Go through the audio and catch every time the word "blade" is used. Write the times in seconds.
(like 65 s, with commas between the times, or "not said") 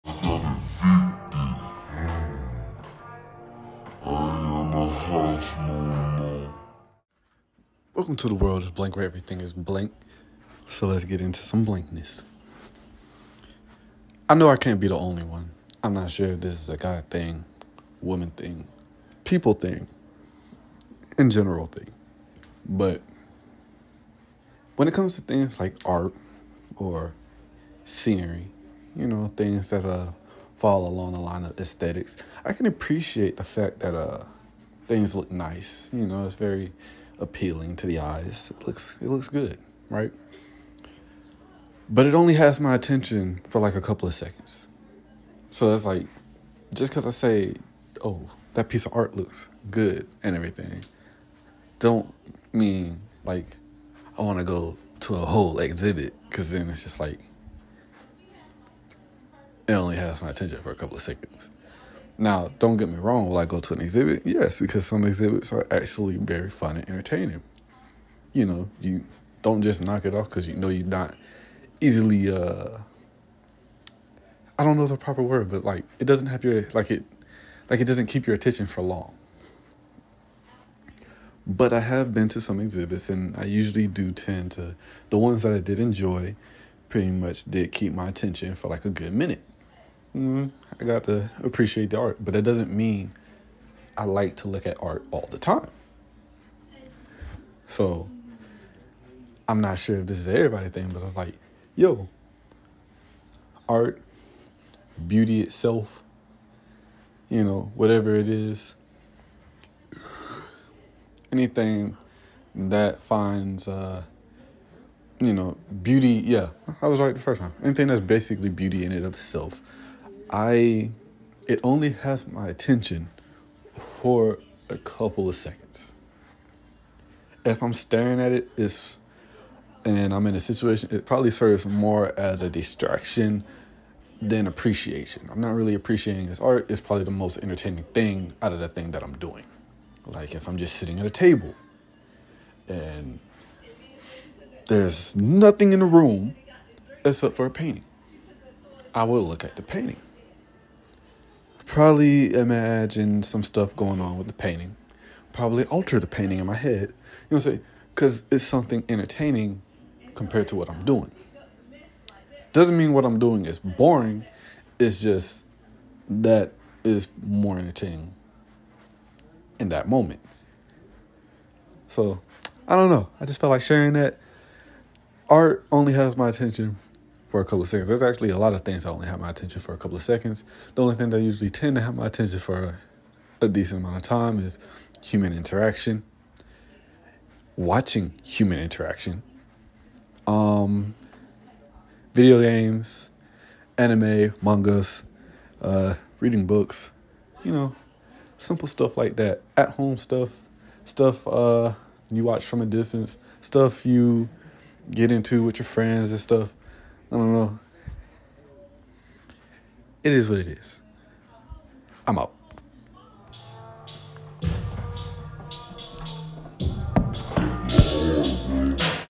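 not said.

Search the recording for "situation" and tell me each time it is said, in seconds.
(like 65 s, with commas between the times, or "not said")
130 s.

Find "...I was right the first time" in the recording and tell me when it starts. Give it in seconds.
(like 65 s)
116 s.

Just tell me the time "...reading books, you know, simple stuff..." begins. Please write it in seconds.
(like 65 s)
196 s.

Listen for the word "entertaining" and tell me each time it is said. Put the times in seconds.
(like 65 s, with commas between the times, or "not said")
66 s, 137 s, 158 s, 167 s.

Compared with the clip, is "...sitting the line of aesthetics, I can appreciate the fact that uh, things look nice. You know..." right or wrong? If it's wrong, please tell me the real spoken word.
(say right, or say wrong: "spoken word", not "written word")
wrong: "along", not "sitting".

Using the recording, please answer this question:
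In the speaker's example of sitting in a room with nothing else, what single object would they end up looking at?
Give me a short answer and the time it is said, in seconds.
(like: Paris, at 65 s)
A painting, at 147 s.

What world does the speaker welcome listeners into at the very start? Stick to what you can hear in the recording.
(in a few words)
The world of blank.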